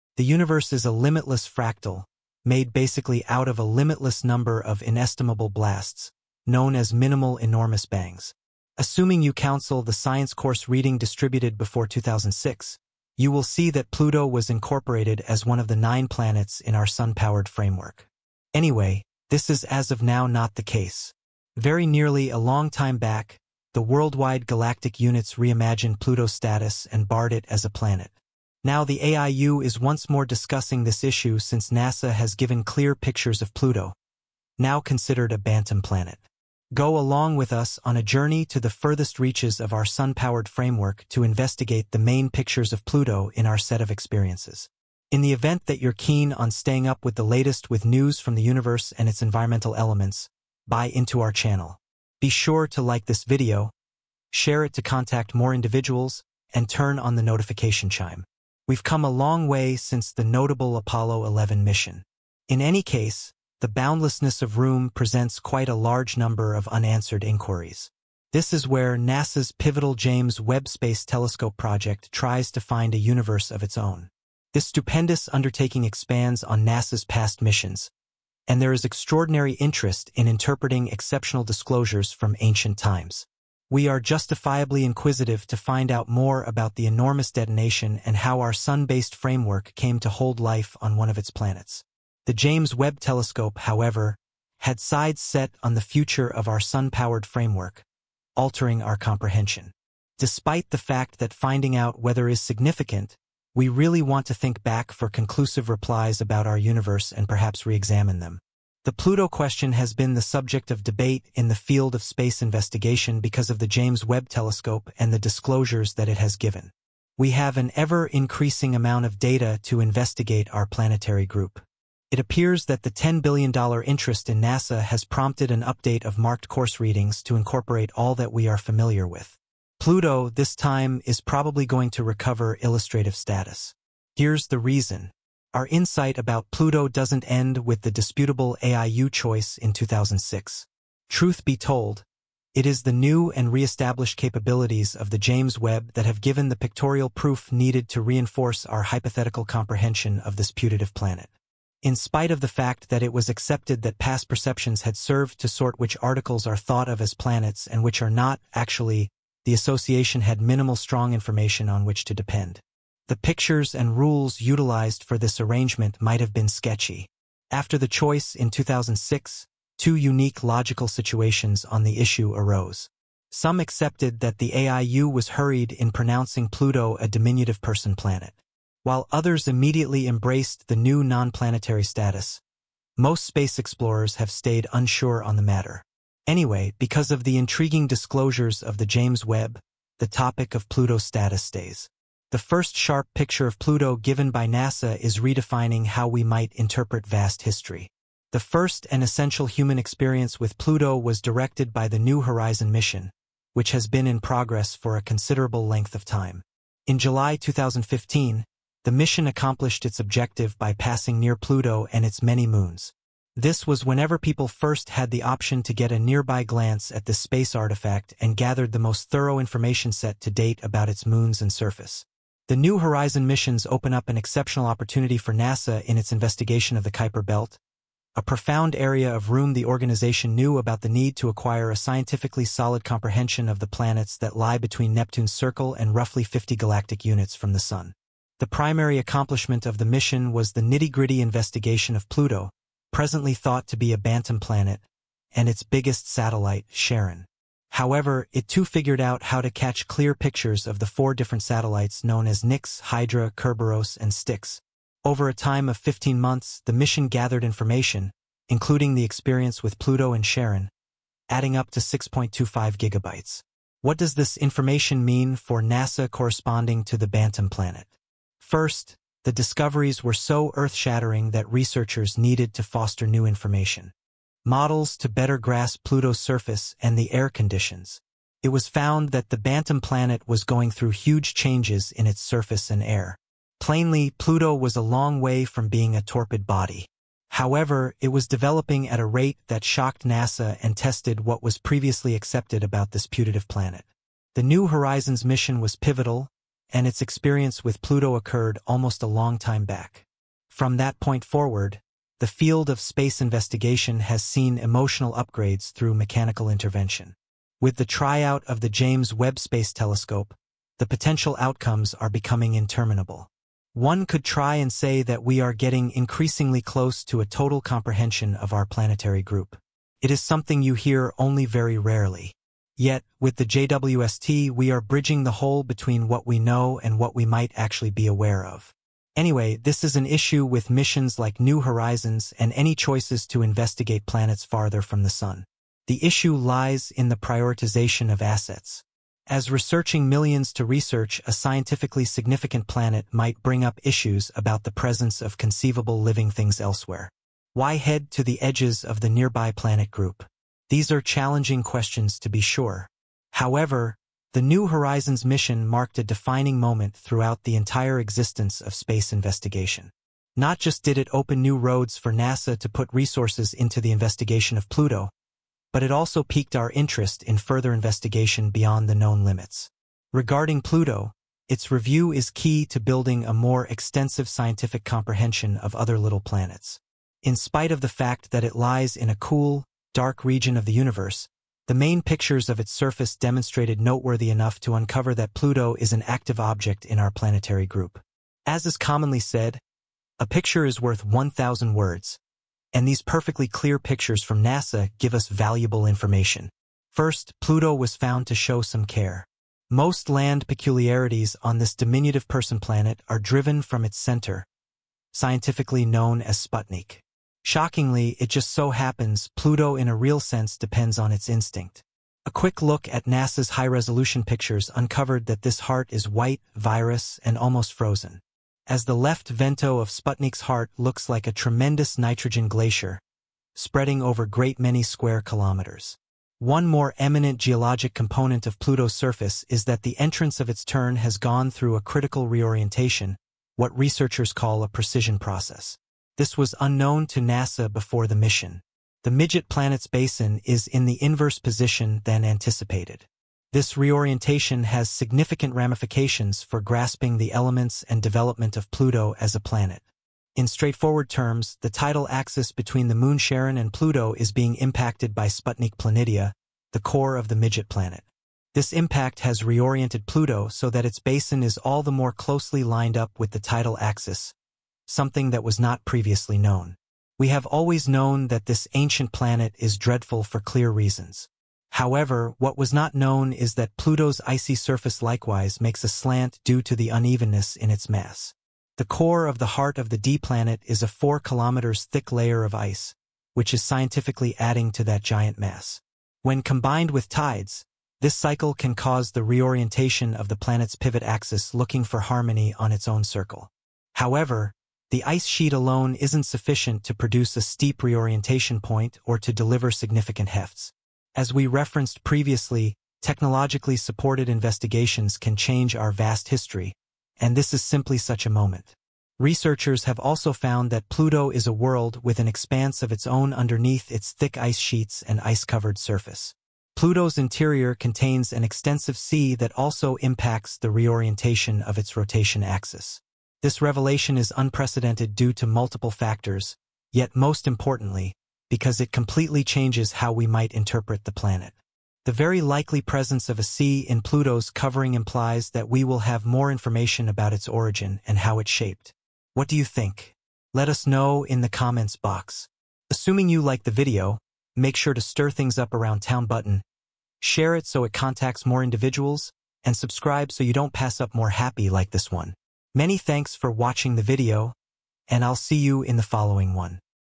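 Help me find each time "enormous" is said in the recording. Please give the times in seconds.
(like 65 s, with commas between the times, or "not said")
7 s, 86 s.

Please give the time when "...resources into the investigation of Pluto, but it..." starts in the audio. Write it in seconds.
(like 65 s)
362 s.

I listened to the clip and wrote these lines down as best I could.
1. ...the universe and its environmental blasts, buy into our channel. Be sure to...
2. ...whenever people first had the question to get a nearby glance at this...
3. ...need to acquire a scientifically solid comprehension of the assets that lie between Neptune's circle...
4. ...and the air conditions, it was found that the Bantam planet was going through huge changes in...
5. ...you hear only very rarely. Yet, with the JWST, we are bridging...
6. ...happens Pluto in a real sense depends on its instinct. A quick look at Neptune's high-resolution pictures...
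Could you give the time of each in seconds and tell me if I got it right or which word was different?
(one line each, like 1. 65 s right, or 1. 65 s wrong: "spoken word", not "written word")
1. 48 s wrong: "elements", not "blasts"
2. 213 s wrong: "option", not "question"
3. 230 s wrong: "planets", not "assets"
4. 276 s right
5. 320 s right
6. 408 s wrong: "NASA", not "Neptune".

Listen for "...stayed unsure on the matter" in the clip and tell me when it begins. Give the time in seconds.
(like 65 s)
184 s.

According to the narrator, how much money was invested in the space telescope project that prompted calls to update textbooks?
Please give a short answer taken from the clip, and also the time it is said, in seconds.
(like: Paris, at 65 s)
$10 billion, at 122 s.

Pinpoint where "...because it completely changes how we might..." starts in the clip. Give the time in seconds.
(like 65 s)
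528 s.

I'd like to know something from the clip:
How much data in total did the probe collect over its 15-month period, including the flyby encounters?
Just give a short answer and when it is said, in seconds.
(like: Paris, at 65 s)
6.25 gigabytes, at 261 s.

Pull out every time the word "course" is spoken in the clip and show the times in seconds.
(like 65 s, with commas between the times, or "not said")
10 s, 126 s.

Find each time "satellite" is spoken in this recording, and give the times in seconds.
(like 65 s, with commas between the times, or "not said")
246 s, 251 s.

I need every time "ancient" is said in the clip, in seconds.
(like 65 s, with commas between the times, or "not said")
82 s, 468 s.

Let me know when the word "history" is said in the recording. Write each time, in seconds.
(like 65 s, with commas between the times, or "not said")
197 s, 506 s.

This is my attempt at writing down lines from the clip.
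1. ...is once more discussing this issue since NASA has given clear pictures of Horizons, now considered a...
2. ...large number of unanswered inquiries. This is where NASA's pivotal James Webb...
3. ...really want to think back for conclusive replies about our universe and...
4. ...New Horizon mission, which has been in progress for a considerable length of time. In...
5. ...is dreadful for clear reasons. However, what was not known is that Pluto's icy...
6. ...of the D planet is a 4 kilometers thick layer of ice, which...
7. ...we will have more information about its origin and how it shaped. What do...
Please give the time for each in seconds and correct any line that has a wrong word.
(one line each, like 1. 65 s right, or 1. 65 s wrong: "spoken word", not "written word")
1. 29 s wrong: "Pluto", not "Horizons"
2. 65 s right
3. 103 s right
4. 201 s right
5. 469 s right
6. 479 s right
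7. 535 s right.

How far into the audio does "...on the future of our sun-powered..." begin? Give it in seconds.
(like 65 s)
95 s.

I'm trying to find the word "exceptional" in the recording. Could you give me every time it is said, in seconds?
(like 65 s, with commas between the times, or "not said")
80 s, 224 s.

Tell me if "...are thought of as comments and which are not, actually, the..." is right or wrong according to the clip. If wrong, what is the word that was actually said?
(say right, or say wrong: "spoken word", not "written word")
wrong: "planets", not "comments".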